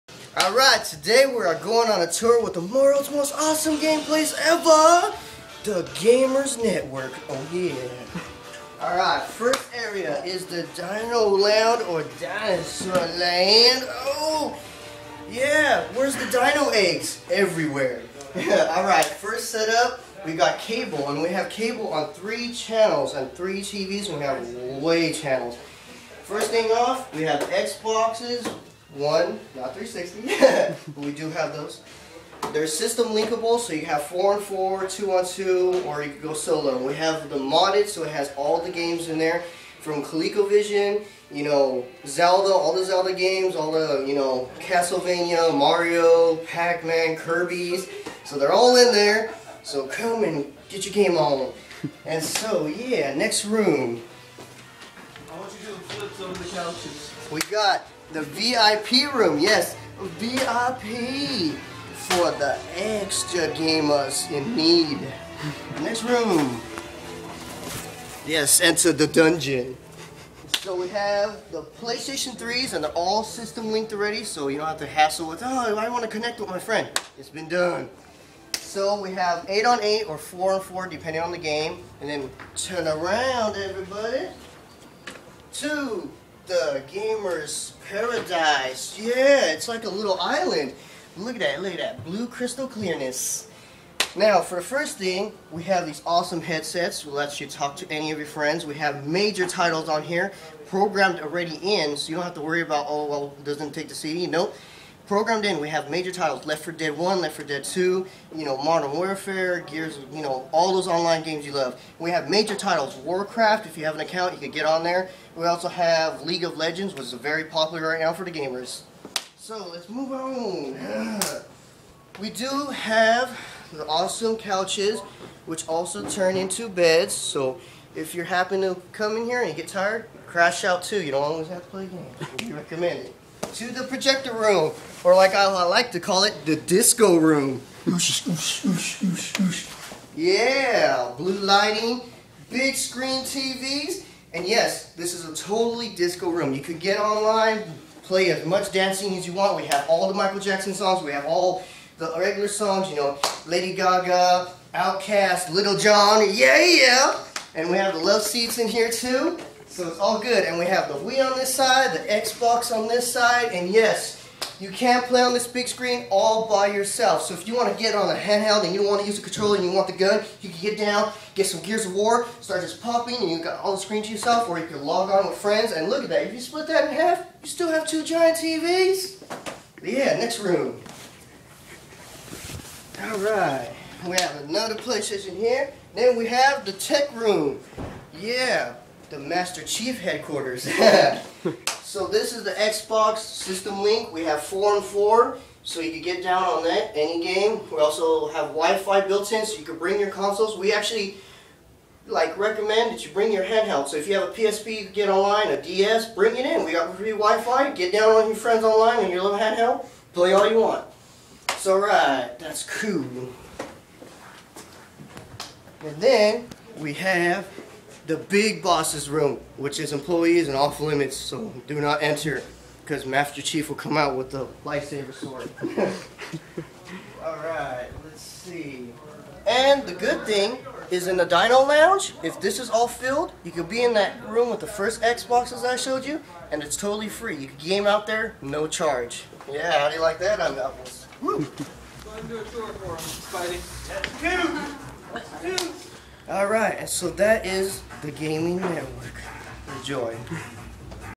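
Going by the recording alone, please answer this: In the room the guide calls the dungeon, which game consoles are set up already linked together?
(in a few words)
PlayStation 3s.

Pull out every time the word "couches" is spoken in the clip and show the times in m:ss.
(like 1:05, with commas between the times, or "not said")
0:56, 2:04.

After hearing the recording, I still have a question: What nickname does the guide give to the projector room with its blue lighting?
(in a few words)
the disco room.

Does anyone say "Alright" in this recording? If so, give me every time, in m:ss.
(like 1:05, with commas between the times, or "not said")
0:00, 0:08, 0:18, 3:03, 3:47, 4:06.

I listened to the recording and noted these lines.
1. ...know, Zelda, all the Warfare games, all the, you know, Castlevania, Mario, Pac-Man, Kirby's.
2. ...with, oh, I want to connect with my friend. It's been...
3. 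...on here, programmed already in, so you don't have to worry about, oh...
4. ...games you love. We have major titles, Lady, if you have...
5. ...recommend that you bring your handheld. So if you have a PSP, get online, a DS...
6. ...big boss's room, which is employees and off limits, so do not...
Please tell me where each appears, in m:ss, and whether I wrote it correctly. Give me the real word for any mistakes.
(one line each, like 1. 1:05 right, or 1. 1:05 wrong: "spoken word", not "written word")
1. 0:41 wrong: "Zelda", not "Warfare"
2. 1:15 right
3. 1:39 right
4. 1:51 wrong: "Warcraft", not "Lady"
5. 3:22 right
6. 3:38 right.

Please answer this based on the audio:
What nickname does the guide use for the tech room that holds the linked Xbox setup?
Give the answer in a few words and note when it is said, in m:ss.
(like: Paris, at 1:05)
Master Chief headquarters, at 3:09.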